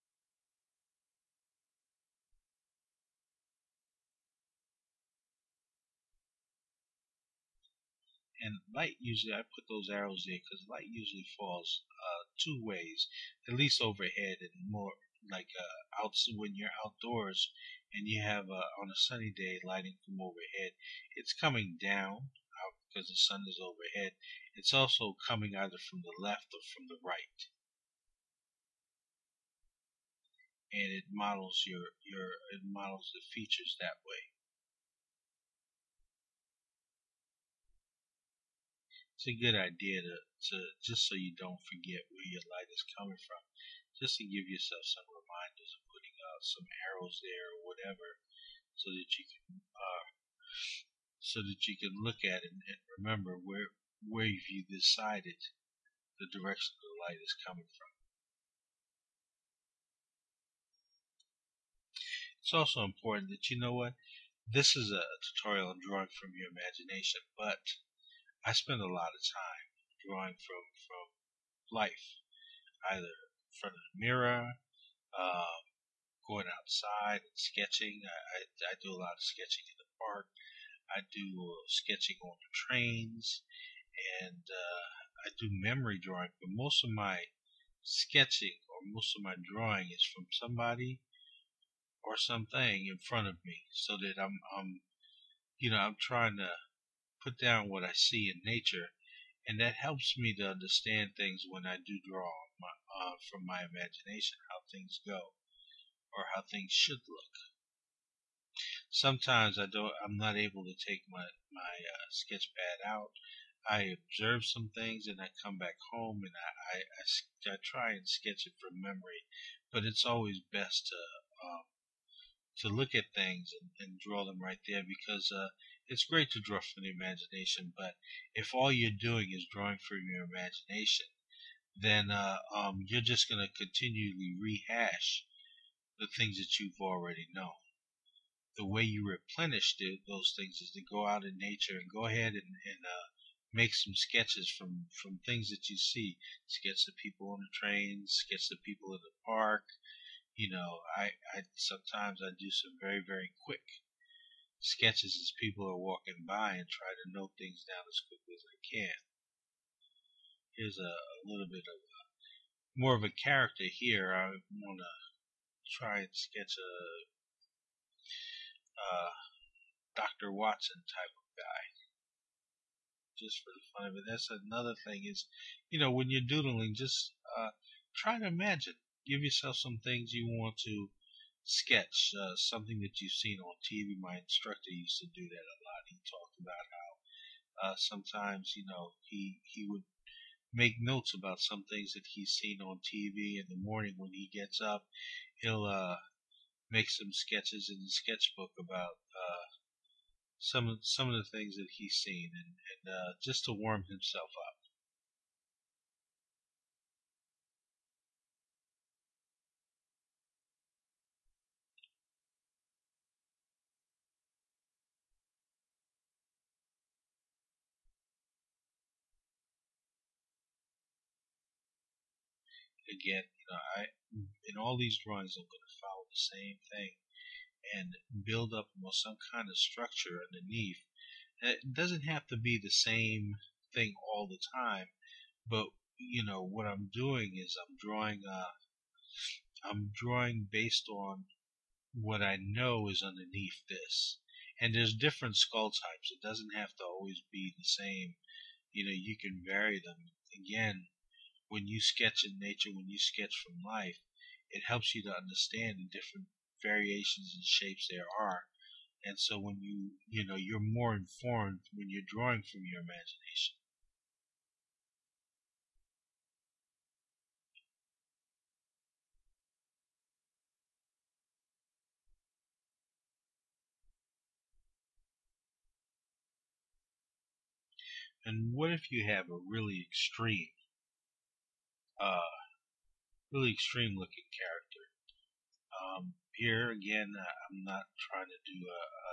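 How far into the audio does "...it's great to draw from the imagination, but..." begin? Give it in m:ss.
2:05.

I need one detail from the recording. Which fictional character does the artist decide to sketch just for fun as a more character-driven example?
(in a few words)
Dr. Watson.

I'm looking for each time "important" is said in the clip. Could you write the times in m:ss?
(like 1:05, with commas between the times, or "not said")
1:02.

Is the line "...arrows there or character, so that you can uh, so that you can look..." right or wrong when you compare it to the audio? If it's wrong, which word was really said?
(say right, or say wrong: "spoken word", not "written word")
wrong: "whatever", not "character".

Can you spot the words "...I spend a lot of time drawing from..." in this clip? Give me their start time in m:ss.
1:08.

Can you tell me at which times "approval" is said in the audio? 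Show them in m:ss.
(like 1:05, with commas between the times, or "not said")
not said.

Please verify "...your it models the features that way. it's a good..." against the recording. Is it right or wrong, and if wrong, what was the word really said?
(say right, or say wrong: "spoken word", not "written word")
right.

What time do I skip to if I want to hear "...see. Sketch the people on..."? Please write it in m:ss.
2:25.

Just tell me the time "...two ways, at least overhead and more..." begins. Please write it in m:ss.
0:12.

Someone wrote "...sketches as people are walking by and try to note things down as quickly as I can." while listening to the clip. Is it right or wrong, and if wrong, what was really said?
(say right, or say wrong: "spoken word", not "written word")
right.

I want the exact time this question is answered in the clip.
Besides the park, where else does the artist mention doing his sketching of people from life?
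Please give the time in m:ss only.
1:22.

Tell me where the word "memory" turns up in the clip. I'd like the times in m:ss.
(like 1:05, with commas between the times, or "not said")
1:25, 1:58.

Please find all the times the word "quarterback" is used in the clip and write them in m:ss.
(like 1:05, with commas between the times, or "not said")
not said.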